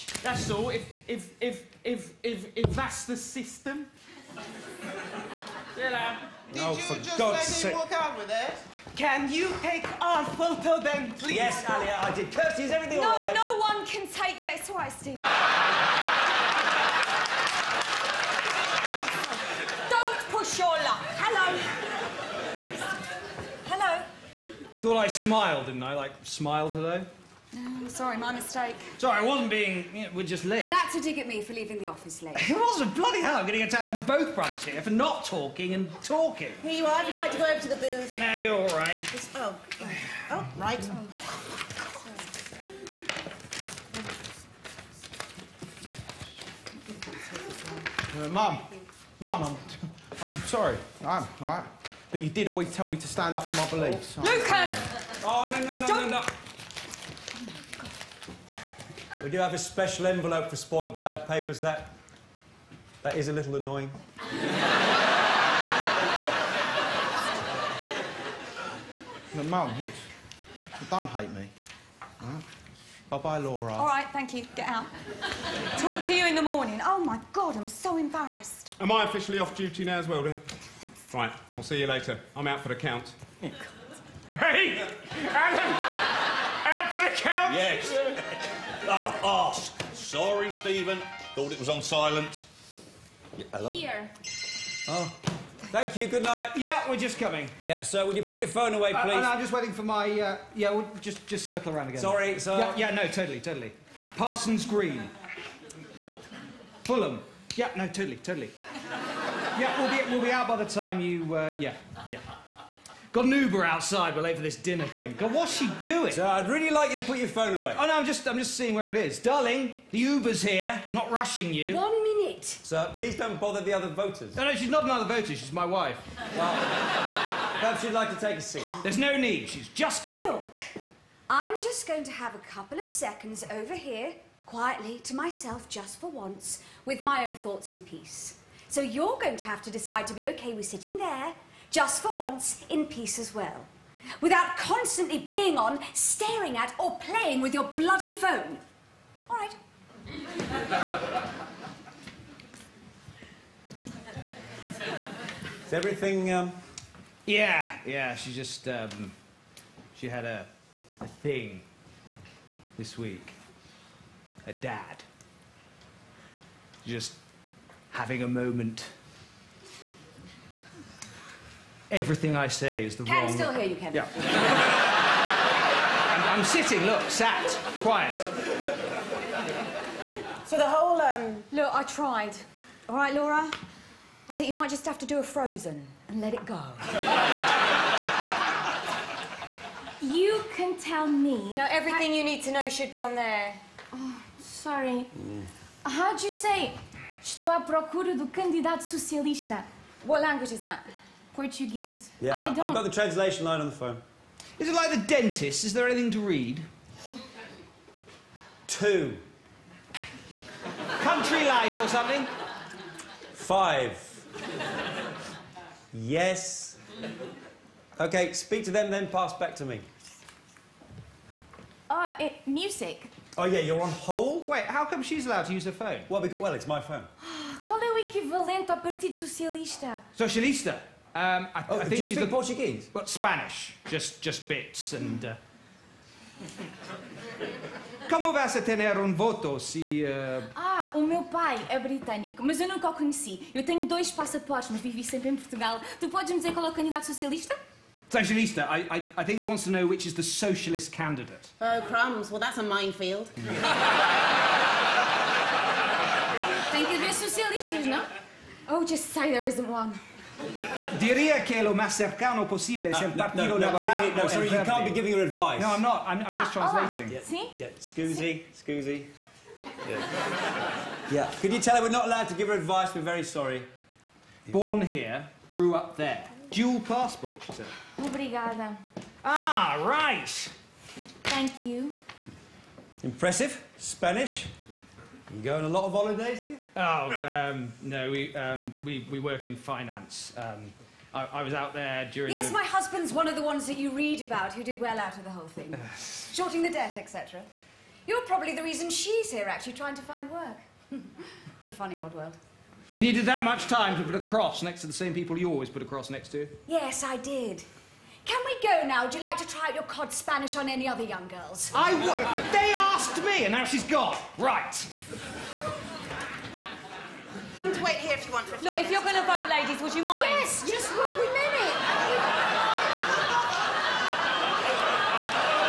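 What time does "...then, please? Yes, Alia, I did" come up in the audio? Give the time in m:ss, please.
0:10.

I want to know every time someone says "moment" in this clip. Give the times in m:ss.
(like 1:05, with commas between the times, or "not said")
2:48.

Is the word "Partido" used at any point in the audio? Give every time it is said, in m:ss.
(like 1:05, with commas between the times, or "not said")
3:48, 4:23.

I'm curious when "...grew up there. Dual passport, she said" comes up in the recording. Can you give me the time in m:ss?
4:35.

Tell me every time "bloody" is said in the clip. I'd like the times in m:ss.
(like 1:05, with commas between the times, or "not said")
0:32, 2:27.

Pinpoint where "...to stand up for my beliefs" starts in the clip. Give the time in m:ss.
0:52.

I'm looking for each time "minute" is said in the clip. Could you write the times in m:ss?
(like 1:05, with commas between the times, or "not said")
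2:02, 5:21.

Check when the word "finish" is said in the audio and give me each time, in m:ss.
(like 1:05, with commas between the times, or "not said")
not said.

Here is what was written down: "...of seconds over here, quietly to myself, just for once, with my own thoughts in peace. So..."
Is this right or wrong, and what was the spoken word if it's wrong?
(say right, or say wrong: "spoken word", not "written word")
right.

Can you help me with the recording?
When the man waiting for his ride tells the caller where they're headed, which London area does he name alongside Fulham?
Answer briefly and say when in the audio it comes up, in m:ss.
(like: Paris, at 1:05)
Parsons Green, at 1:44.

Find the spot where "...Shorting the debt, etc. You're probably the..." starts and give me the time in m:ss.
4:56.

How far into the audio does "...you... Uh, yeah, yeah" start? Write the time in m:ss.
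1:51.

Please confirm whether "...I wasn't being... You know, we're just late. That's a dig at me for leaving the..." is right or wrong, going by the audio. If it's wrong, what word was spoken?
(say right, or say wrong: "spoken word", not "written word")
right.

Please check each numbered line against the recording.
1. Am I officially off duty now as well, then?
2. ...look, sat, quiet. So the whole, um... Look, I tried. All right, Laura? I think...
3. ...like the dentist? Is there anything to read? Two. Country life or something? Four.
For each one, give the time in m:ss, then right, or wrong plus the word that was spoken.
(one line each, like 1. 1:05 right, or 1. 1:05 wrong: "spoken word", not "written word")
1. 1:18 right
2. 2:56 right
3. 3:24 wrong: "Five", not "Four".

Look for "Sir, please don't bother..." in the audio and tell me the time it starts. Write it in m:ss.
2:02.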